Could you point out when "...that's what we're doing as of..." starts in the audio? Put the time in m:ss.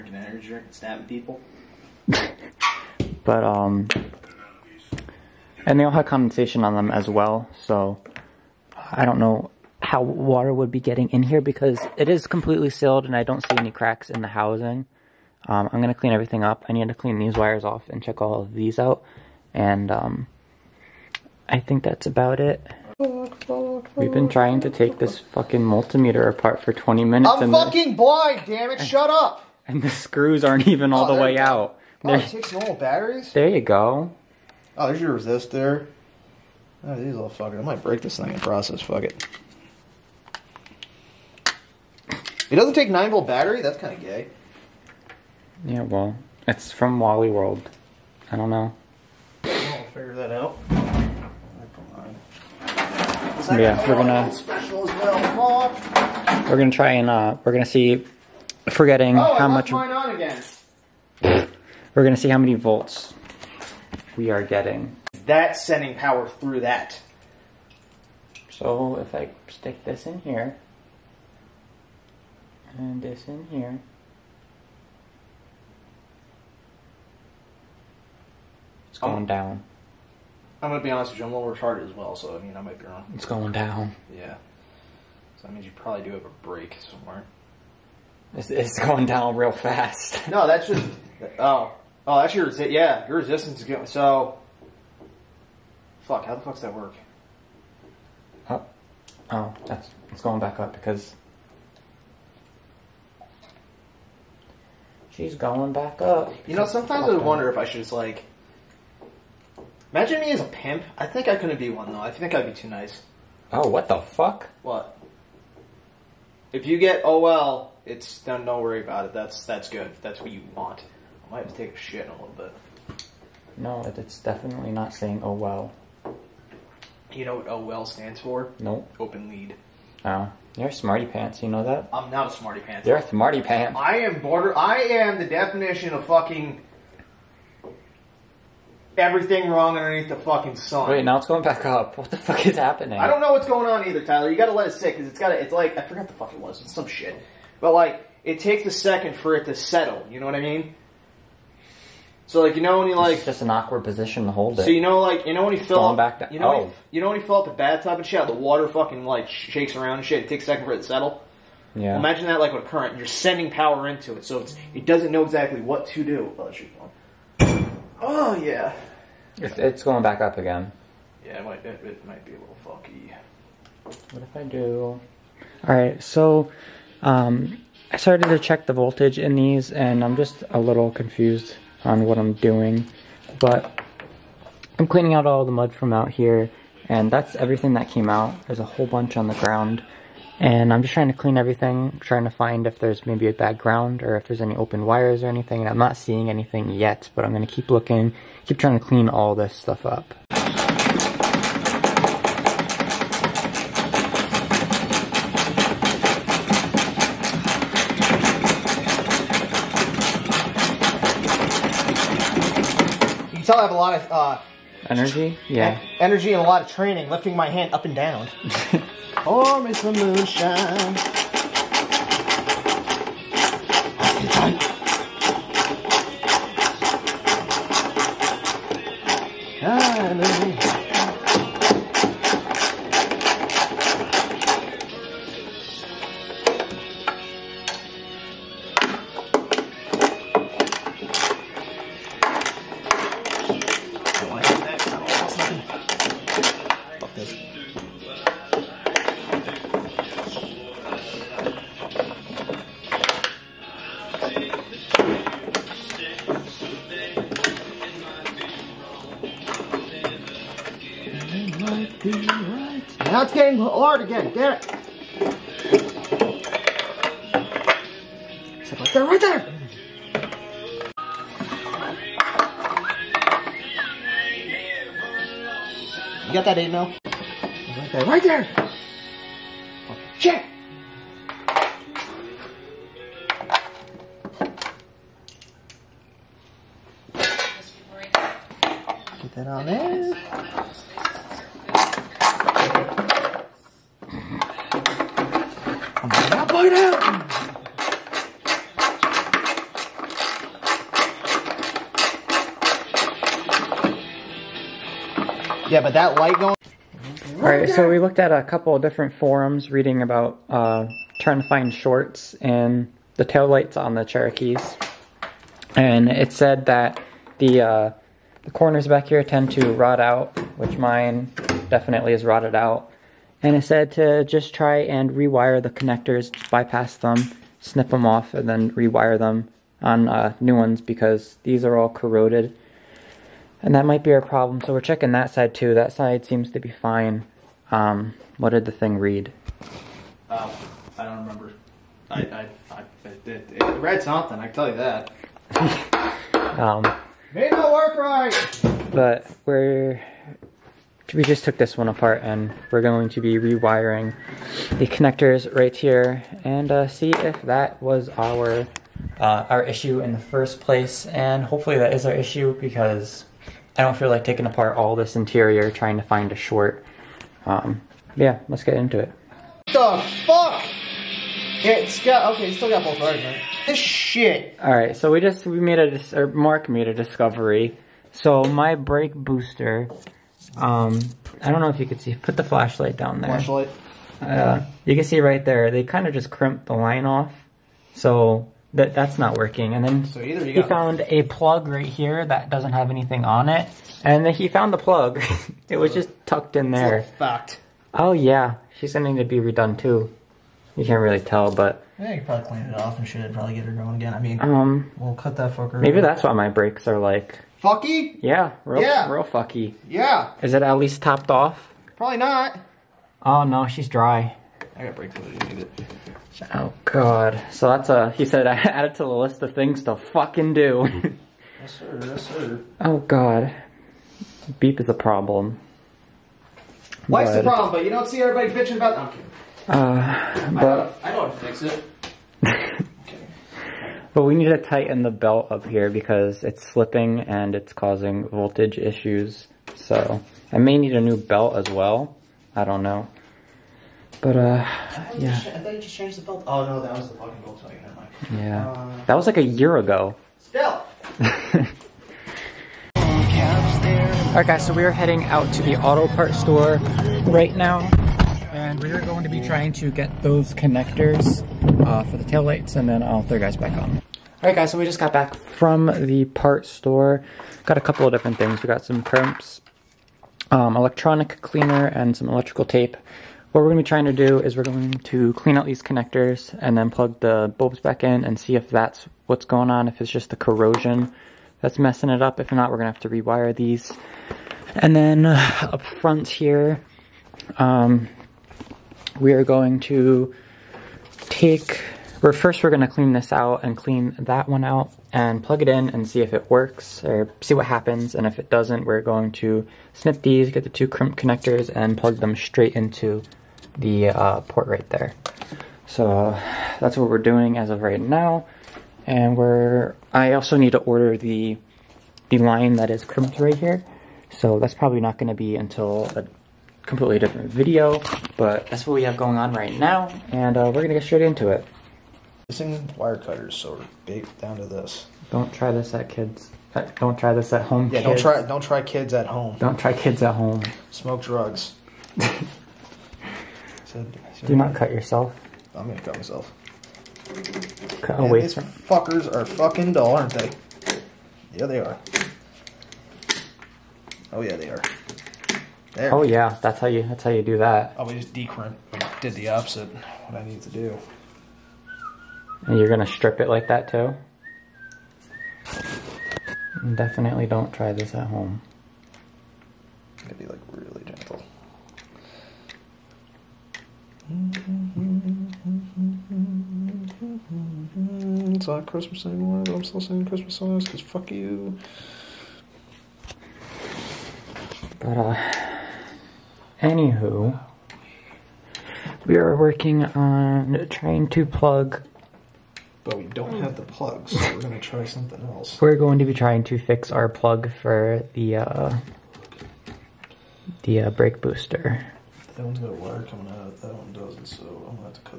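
8:26.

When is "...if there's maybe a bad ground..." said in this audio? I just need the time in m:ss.
3:12.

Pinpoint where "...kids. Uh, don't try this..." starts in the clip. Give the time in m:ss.
8:46.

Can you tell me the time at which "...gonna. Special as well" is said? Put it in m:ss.
0:53.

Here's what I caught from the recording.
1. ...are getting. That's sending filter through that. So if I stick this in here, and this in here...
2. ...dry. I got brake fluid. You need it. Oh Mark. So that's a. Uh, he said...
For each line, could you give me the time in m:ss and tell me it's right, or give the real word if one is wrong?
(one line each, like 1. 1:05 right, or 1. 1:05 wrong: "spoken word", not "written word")
1. 1:04 wrong: "power", not "filter"
2. 6:53 wrong: "God", not "Mark".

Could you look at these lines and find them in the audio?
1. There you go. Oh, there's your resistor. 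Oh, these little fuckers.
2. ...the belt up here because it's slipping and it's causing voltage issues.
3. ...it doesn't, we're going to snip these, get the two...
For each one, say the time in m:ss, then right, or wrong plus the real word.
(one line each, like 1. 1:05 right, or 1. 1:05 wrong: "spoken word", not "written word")
1. 0:33 right
2. 7:15 right
3. 8:18 right.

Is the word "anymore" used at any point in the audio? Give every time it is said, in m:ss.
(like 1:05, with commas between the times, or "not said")
9:29.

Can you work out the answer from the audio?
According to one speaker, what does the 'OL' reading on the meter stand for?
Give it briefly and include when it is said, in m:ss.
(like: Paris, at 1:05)
Open lead, at 2:08.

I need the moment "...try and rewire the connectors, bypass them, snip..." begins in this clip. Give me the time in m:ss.
5:24.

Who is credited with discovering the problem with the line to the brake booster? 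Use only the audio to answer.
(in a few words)
Mark.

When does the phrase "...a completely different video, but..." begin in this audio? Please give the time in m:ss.
8:36.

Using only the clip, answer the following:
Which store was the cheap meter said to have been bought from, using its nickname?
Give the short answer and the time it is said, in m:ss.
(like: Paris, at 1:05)
Wally World, at 0:46.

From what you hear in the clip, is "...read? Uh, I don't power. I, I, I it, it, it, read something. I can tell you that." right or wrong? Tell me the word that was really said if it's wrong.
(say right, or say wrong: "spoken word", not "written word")
wrong: "remember", not "power".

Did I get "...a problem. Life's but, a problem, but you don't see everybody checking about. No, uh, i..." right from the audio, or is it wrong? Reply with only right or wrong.
wrong.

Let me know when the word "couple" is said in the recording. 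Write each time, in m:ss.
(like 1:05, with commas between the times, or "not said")
5:08, 7:47.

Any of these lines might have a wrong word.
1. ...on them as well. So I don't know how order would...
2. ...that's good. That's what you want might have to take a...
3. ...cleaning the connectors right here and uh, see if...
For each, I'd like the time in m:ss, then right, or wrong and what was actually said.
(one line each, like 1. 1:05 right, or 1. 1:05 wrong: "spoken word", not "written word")
1. 0:06 wrong: "water", not "order"
2. 1:59 right
3. 5:53 wrong: "rewiring", not "cleaning".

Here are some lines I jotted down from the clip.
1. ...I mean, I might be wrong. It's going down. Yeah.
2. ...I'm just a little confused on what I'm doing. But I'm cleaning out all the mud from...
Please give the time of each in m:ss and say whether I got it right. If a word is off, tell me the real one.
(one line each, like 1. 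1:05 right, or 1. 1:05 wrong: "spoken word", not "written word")
1. 1:22 right
2. 3:00 right.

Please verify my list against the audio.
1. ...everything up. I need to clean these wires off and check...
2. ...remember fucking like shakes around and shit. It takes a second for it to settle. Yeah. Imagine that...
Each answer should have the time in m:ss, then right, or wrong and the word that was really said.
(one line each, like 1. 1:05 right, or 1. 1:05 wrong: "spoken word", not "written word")
1. 0:16 right
2. 2:38 wrong: "water", not "remember".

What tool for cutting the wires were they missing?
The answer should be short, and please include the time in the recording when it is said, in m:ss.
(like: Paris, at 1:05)
Wire cutters, at 8:42.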